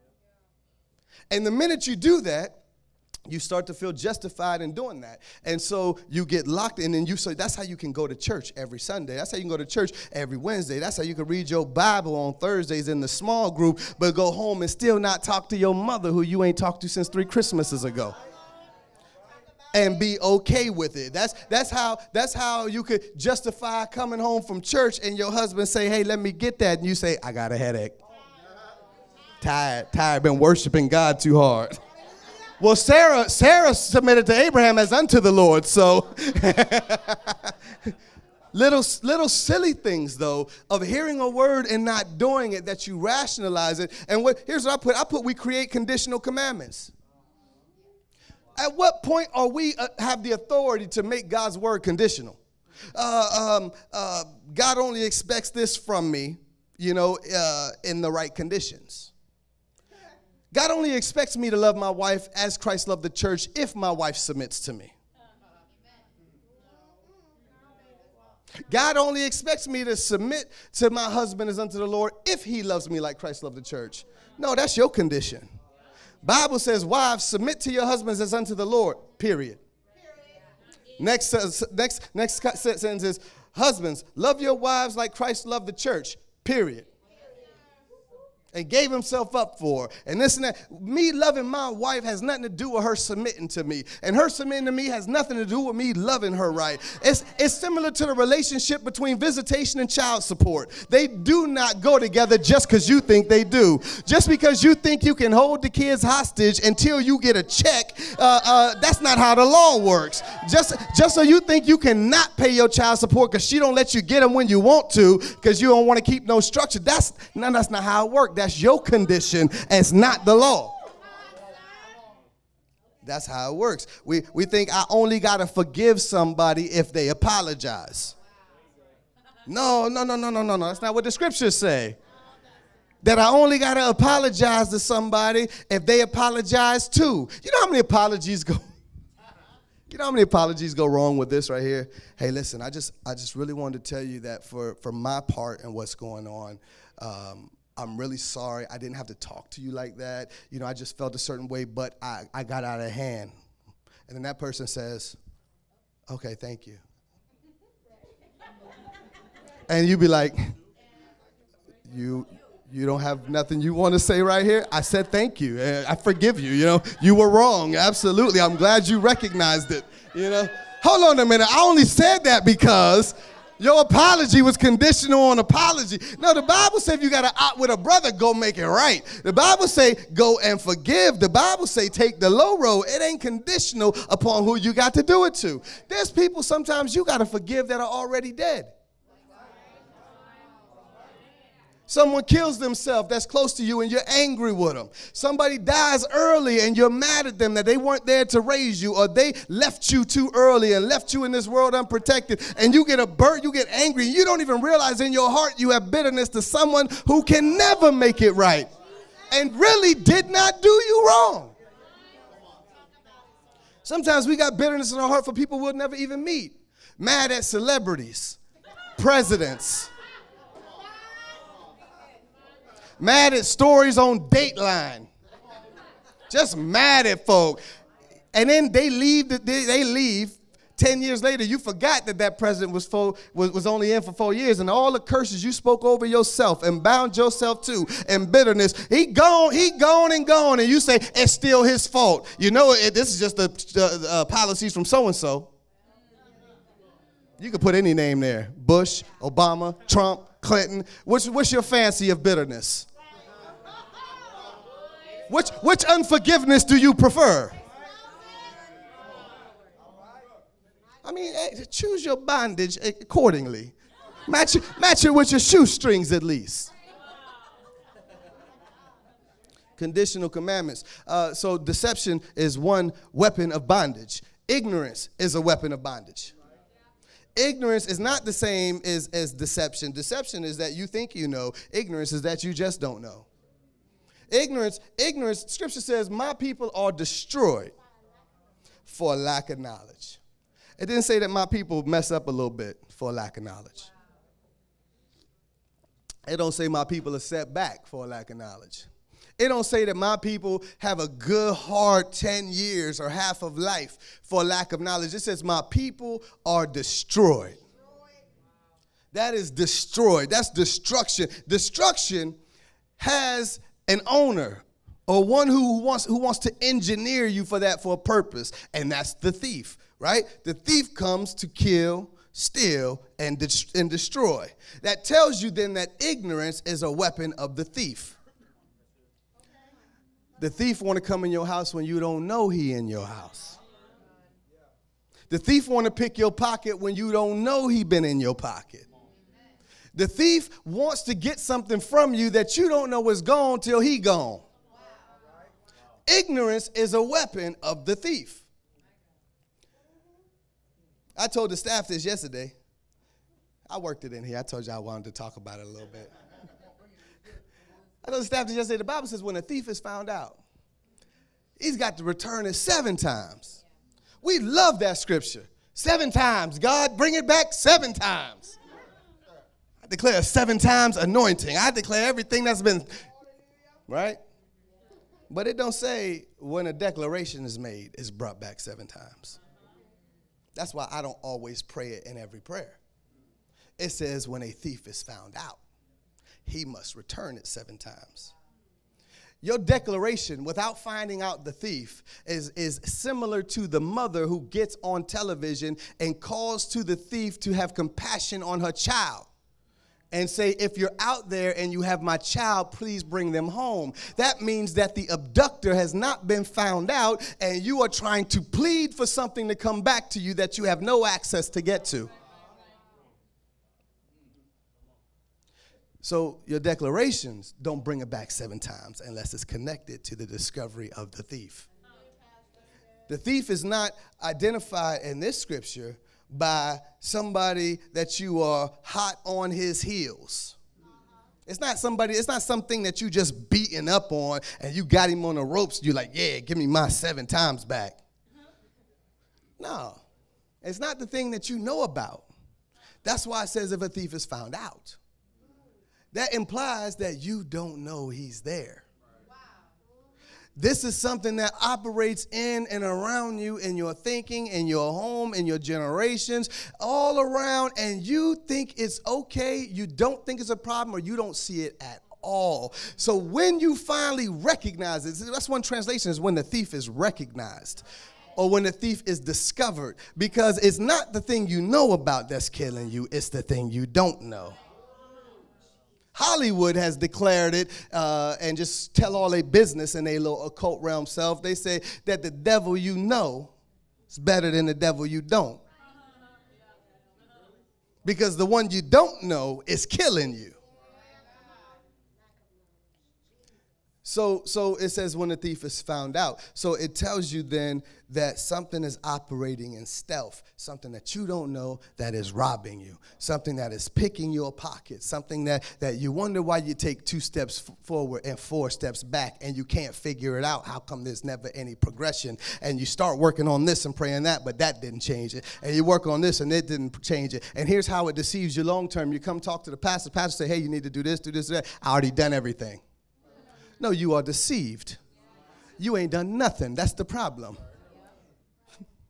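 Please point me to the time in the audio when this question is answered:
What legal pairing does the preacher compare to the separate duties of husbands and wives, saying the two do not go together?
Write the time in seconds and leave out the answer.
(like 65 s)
99 s.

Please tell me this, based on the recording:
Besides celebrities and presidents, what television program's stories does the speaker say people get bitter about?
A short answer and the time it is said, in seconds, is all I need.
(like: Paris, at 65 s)
Dateline, at 224 s.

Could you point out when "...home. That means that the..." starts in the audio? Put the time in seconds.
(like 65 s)
403 s.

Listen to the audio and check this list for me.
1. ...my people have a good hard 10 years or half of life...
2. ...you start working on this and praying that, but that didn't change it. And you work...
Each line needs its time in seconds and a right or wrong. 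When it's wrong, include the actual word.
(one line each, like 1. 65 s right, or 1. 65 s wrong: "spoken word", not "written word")
1. 299 s right
2. 512 s right.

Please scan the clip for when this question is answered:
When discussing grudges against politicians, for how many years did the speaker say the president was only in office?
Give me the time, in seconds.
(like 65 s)
234 s.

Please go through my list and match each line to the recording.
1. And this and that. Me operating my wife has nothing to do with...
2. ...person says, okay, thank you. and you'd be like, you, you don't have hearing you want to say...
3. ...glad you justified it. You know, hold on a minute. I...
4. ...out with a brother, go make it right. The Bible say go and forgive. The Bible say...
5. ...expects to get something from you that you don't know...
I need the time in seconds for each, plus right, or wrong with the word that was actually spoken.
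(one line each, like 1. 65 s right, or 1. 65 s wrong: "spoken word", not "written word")
1. 90 s wrong: "loving", not "operating"
2. 154 s wrong: "nothing", not "hearing"
3. 168 s wrong: "recognized", not "justified"
4. 177 s right
5. 340 s wrong: "wants", not "expects".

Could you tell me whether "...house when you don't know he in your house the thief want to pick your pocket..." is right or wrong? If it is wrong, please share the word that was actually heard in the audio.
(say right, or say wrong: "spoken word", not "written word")
right.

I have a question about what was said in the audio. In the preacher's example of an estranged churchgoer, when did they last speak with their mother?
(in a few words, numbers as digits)
three Christmases ago.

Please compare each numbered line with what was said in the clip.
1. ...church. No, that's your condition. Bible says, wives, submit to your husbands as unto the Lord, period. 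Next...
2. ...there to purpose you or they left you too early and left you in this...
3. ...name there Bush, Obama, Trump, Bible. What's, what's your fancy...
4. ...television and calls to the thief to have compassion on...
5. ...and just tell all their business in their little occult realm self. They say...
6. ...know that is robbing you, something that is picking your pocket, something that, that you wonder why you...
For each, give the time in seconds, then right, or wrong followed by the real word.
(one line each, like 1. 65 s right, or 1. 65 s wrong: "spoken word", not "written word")
1. 73 s right
2. 198 s wrong: "raise", not "purpose"
3. 247 s wrong: "Clinton", not "Bible"
4. 395 s right
5. 478 s right
6. 501 s right.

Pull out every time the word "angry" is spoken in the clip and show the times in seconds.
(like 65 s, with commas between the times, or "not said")
194 s, 203 s.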